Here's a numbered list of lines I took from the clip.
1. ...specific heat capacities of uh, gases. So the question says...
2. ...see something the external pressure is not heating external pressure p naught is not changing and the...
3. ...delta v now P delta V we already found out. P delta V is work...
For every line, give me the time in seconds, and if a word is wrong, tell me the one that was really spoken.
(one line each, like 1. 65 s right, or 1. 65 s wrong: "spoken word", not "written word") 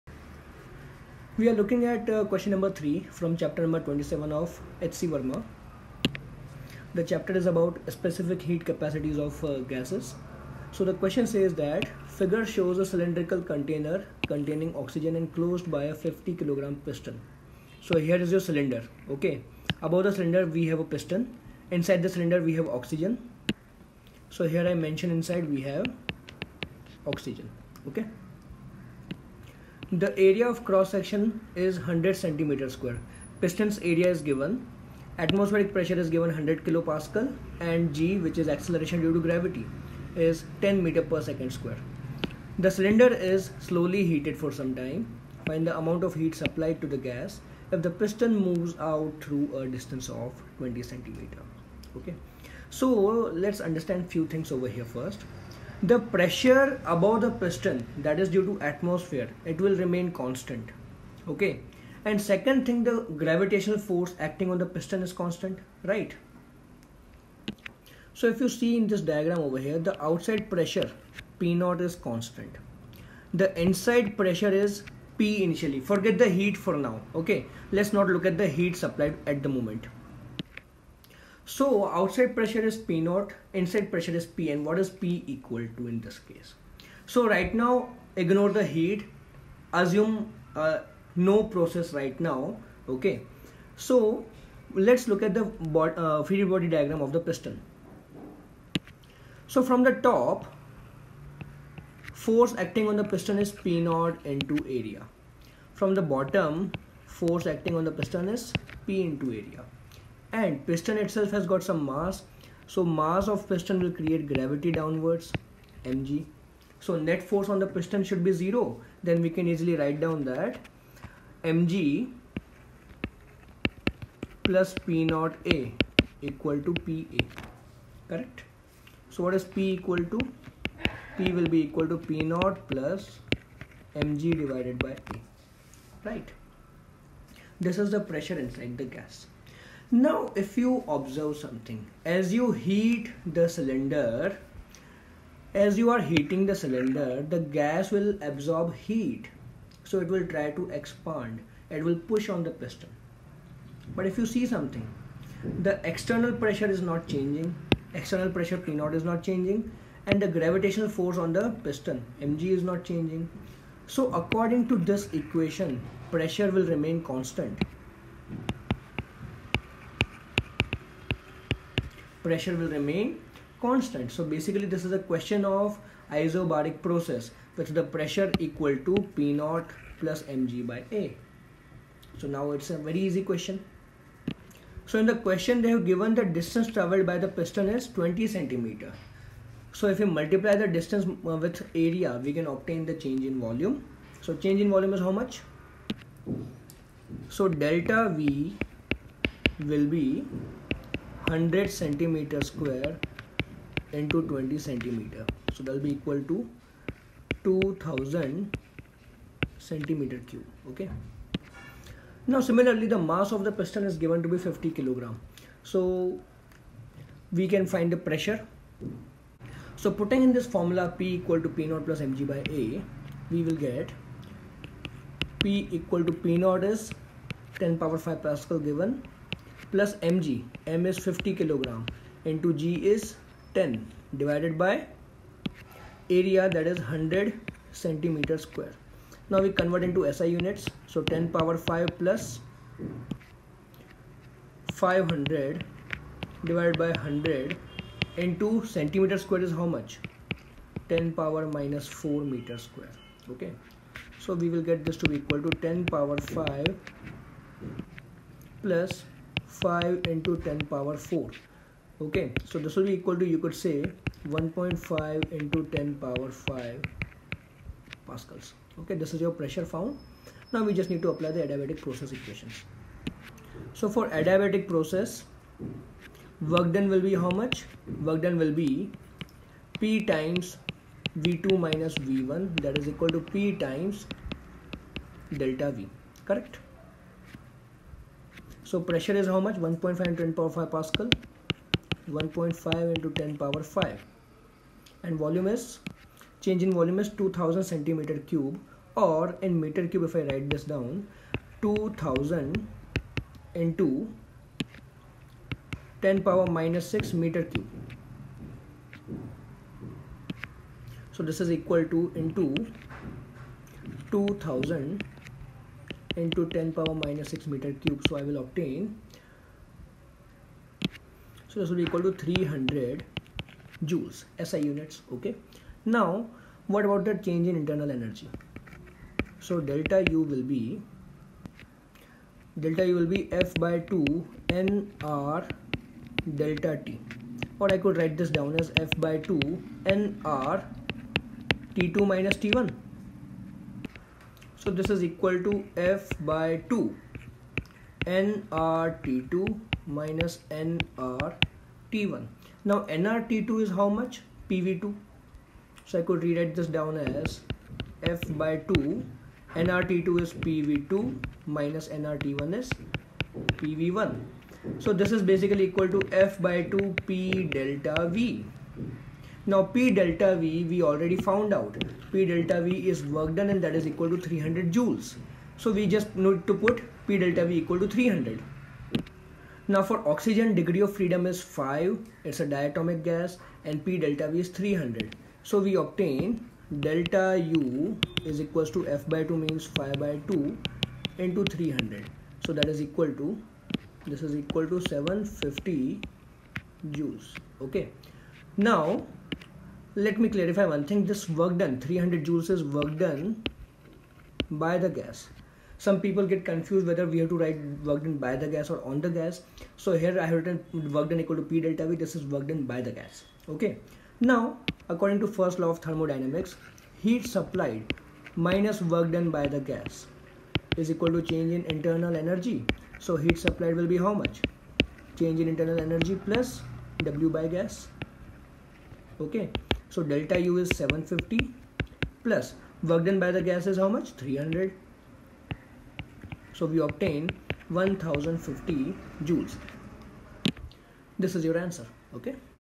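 1. 7 s right
2. 154 s wrong: "changing", not "heating"
3. 367 s right.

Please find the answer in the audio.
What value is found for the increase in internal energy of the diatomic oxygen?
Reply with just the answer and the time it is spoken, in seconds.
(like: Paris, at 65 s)
750 joules, at 394 s.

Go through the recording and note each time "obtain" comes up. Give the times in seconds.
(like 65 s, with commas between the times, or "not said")
192 s, 318 s, 385 s, 436 s.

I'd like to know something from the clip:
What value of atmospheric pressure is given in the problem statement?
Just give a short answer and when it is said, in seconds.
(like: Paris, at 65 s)
100 kilopascal, at 36 s.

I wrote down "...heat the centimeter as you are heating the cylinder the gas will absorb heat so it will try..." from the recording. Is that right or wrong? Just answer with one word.
wrong.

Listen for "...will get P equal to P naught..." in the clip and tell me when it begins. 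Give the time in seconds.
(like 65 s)
223 s.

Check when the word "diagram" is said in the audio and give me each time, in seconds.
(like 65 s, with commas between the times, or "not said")
69 s, 96 s.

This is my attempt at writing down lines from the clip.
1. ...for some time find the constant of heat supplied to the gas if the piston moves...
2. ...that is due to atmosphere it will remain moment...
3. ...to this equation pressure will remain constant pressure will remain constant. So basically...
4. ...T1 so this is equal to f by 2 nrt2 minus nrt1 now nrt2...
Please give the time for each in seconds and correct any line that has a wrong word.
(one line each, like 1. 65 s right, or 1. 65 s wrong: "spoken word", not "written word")
1. 44 s wrong: "amount", not "constant"
2. 57 s wrong: "constant", not "moment"
3. 164 s right
4. 342 s right.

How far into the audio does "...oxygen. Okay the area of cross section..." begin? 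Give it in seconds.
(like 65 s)
27 s.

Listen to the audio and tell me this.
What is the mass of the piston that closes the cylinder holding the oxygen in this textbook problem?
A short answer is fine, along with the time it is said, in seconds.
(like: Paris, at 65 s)
50 kg, at 15 s.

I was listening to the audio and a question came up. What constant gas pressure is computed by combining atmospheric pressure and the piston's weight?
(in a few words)
1.5 × 10^5 pascals.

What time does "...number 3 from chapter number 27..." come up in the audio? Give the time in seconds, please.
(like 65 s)
2 s.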